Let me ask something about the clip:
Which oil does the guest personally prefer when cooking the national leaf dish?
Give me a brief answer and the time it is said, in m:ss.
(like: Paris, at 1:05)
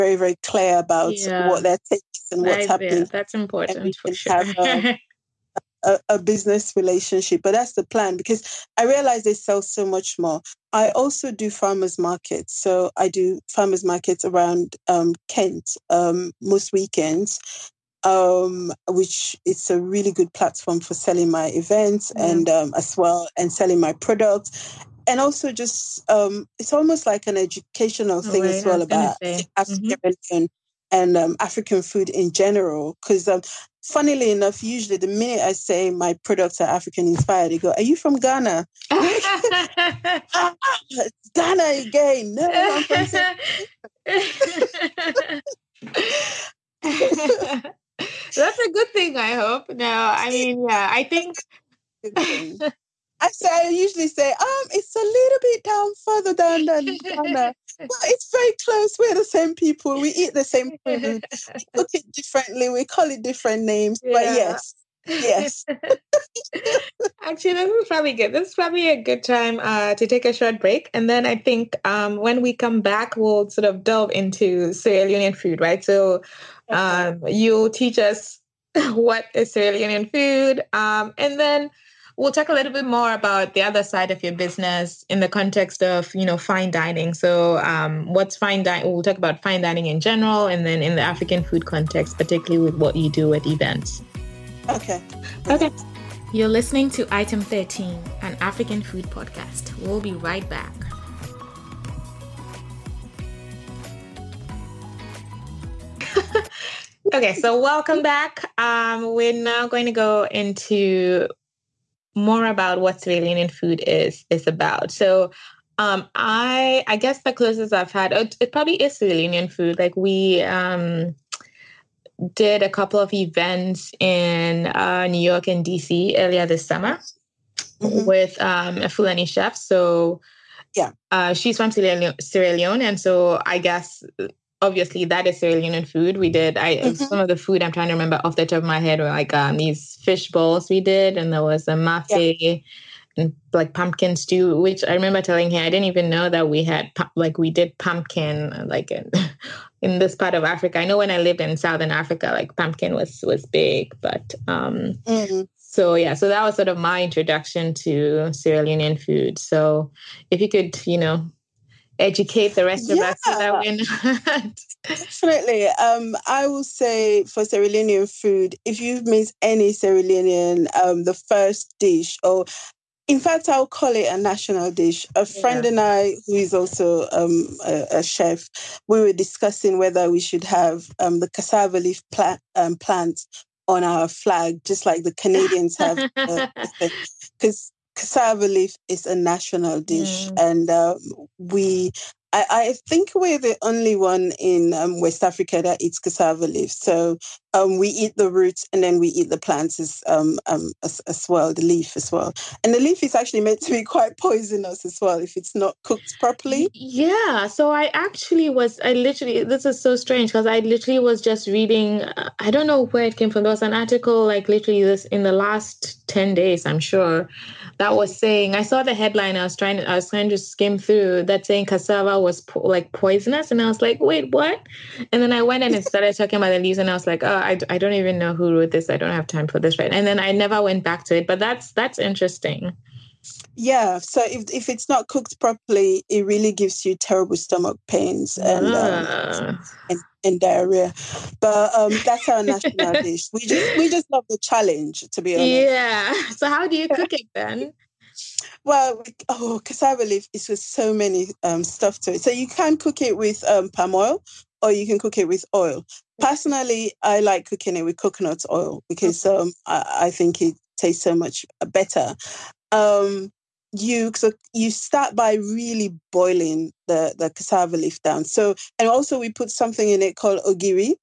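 Coconut oil, at 4:17.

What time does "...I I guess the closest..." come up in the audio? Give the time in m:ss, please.
1:56.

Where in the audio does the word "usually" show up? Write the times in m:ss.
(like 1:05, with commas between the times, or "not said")
0:34, 0:53.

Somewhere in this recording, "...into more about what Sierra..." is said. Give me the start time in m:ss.
1:50.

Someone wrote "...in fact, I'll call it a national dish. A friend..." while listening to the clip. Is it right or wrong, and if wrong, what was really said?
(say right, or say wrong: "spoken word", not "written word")
right.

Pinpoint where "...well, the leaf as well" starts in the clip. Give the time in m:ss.
3:21.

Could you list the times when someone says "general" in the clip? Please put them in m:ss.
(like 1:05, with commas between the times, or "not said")
0:32, 1:30.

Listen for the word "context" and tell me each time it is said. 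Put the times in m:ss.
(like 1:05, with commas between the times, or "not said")
1:25, 1:31.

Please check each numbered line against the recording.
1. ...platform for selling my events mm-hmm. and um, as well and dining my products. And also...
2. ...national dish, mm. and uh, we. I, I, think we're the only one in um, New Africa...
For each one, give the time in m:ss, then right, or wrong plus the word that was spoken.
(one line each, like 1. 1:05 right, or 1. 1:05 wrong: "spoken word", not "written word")
1. 0:20 wrong: "selling", not "dining"
2. 3:09 wrong: "West", not "New".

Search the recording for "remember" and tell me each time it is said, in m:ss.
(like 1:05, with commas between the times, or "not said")
2:17, 2:24.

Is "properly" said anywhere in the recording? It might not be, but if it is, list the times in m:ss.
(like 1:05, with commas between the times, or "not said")
3:26, 3:55.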